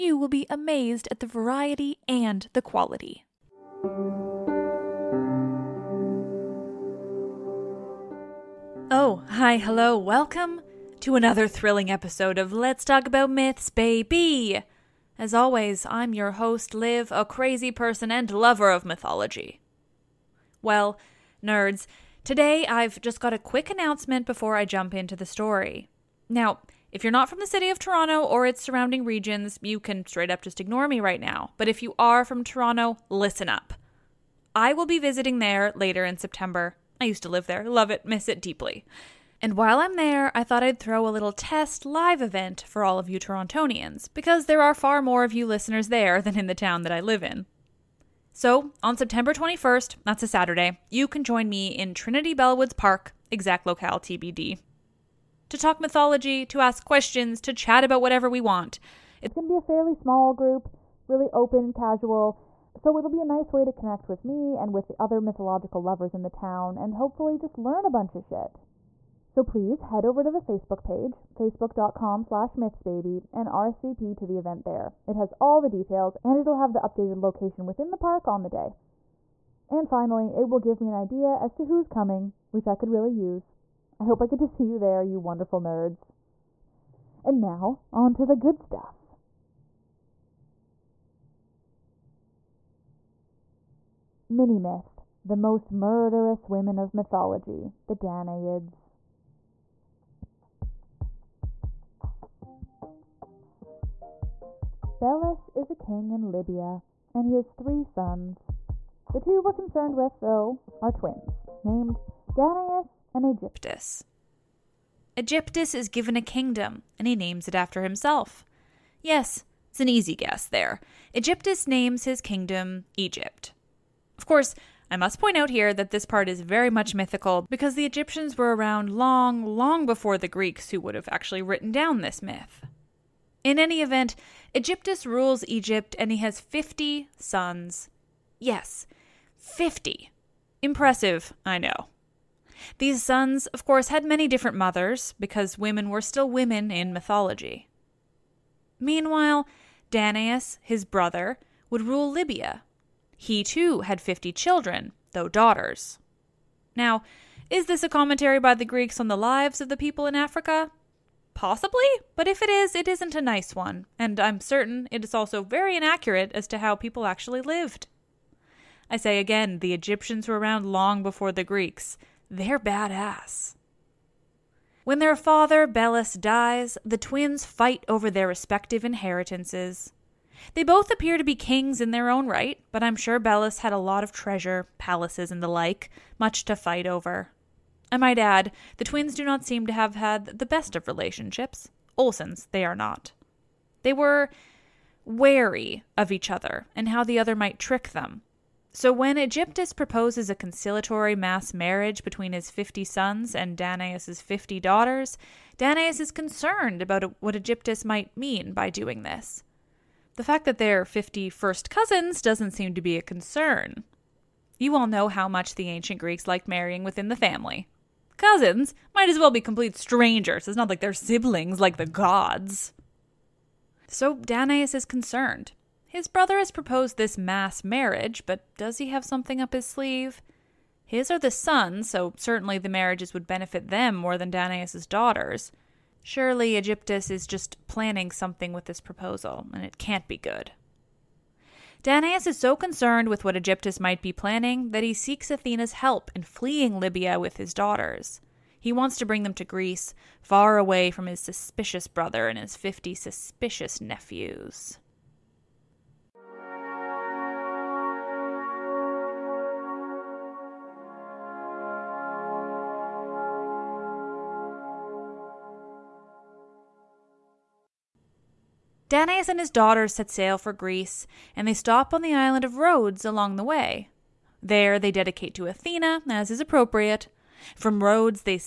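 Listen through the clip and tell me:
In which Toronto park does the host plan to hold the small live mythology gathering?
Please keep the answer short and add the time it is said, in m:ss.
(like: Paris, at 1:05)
Trinity Bellwoods Park, at 0:51.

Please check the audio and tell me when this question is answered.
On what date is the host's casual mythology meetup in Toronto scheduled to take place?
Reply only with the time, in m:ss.
0:48.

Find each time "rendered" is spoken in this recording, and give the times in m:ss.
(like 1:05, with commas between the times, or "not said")
not said.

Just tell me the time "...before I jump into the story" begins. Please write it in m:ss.
0:24.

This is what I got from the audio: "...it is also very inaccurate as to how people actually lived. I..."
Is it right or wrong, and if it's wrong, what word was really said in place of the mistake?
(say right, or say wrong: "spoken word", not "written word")
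right.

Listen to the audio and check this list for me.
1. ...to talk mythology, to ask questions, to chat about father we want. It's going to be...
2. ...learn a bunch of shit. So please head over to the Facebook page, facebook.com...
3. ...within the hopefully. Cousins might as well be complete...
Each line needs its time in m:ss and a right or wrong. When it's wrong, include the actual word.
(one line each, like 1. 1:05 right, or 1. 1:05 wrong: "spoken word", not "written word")
1. 0:55 wrong: "whatever", not "father"
2. 1:07 right
3. 3:36 wrong: "family", not "hopefully".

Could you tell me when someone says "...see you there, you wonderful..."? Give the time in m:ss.
1:24.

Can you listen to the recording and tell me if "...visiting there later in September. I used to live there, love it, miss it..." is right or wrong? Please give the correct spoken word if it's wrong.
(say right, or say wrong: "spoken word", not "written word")
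right.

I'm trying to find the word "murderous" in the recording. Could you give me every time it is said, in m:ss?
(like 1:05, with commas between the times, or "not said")
1:35.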